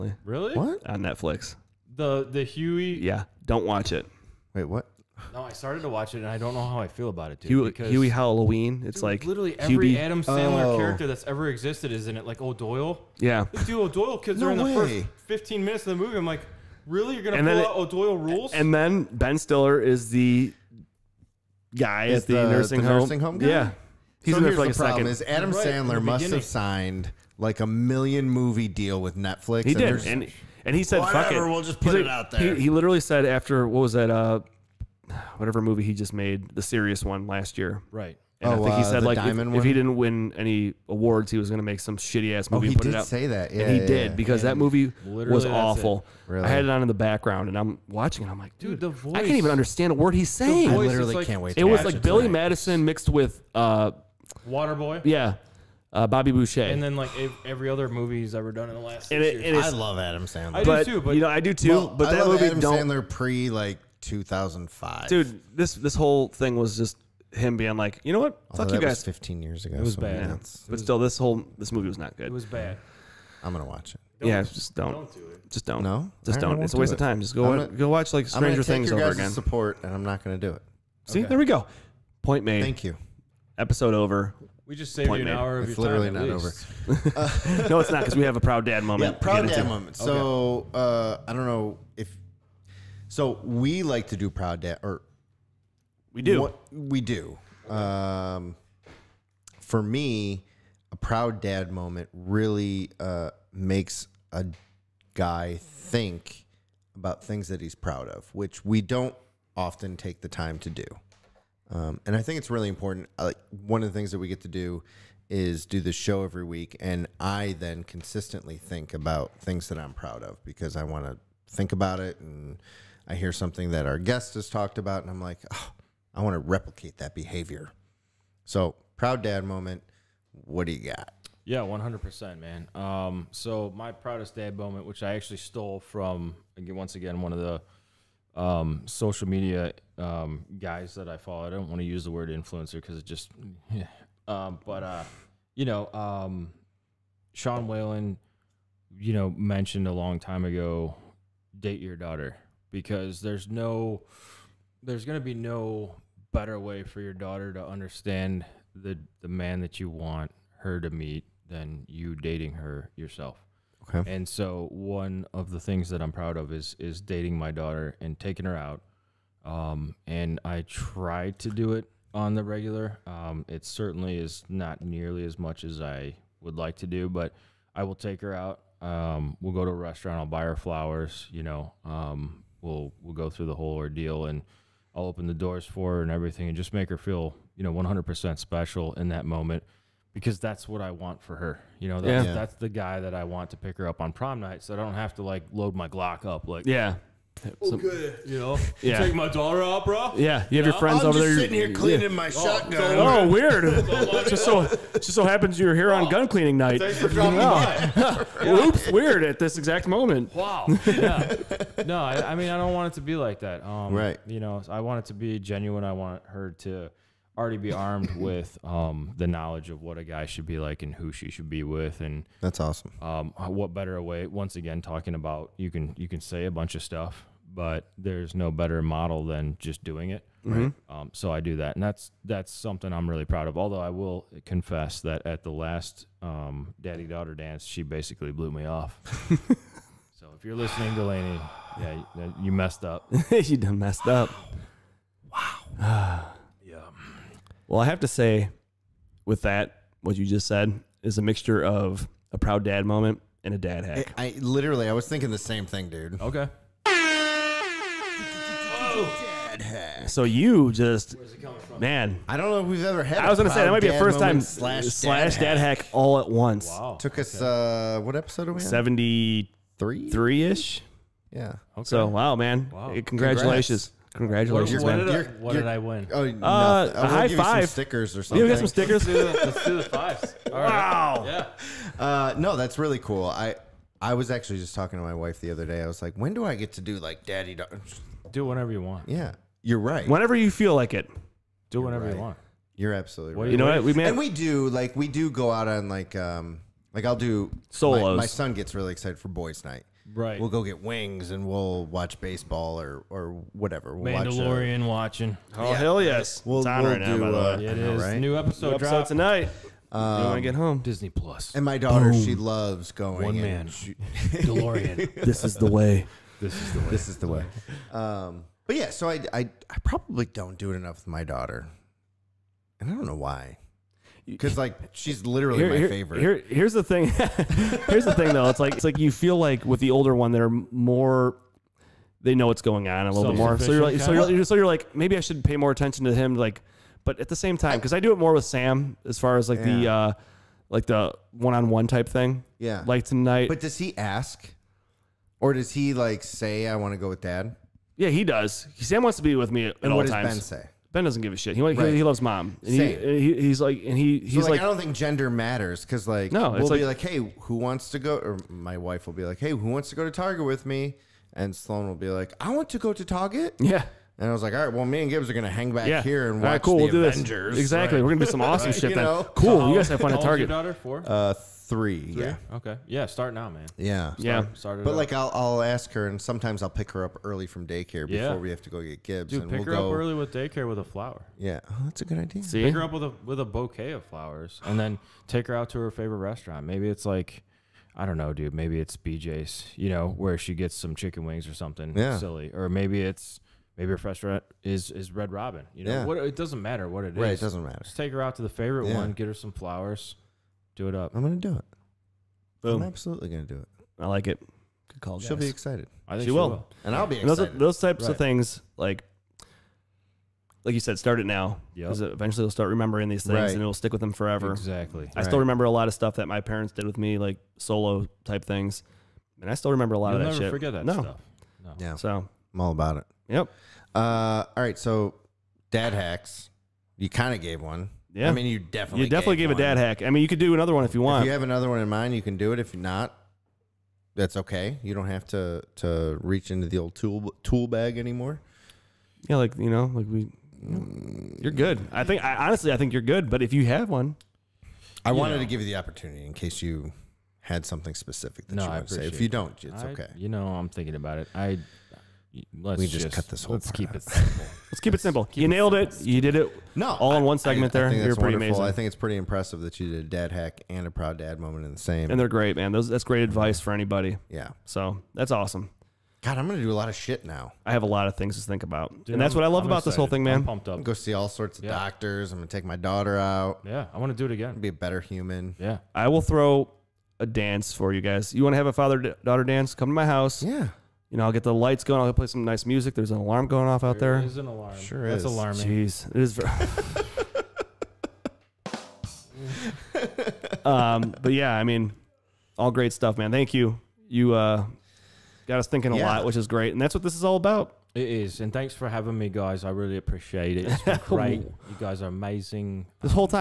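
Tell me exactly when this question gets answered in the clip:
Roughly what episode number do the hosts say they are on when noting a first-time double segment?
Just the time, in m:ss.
4:28.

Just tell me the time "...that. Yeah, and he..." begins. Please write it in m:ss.
0:43.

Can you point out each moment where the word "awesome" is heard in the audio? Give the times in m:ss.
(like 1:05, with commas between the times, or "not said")
3:42, 6:08, 7:45.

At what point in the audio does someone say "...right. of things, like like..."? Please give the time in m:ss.
6:48.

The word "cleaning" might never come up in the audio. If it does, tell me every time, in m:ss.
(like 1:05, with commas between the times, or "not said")
3:21, 3:26.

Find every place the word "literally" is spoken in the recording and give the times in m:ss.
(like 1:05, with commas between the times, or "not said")
0:09, 0:32, 0:50, 1:25, 4:14, 5:25.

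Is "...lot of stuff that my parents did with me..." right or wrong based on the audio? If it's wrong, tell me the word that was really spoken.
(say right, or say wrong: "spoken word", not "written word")
right.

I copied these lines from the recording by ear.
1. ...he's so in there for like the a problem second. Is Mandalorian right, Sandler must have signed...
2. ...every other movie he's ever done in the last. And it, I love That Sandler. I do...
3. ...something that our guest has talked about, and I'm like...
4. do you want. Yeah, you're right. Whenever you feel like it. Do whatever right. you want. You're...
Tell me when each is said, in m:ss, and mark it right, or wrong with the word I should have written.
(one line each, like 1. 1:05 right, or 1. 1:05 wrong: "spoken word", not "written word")
1. 0:24 wrong: "Adam", not "Mandalorian"
2. 0:57 wrong: "Adam", not "That"
3. 2:03 right
4. 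4:48 right.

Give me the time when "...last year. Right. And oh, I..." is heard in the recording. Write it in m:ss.
0:37.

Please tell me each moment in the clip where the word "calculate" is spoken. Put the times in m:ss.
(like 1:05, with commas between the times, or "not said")
not said.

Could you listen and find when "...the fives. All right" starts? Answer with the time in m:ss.
4:39.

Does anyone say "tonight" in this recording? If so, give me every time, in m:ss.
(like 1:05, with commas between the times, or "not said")
0:52, 5:09, 5:43.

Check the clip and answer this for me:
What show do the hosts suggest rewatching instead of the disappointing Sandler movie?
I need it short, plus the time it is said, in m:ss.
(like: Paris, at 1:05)
Stranger Things, at 1:18.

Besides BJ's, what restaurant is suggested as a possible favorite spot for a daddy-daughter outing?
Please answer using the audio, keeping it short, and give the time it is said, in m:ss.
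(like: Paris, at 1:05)
Red Robin, at 6:35.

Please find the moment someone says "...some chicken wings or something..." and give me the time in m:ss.
6:30.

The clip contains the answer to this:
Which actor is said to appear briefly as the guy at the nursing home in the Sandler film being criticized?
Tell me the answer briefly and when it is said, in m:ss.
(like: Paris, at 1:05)
Ben Stiller, at 0:19.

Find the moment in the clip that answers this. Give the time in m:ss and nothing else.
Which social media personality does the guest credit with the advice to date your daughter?
2:27.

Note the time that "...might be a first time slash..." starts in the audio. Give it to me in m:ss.
4:23.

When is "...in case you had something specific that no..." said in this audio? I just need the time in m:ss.
7:26.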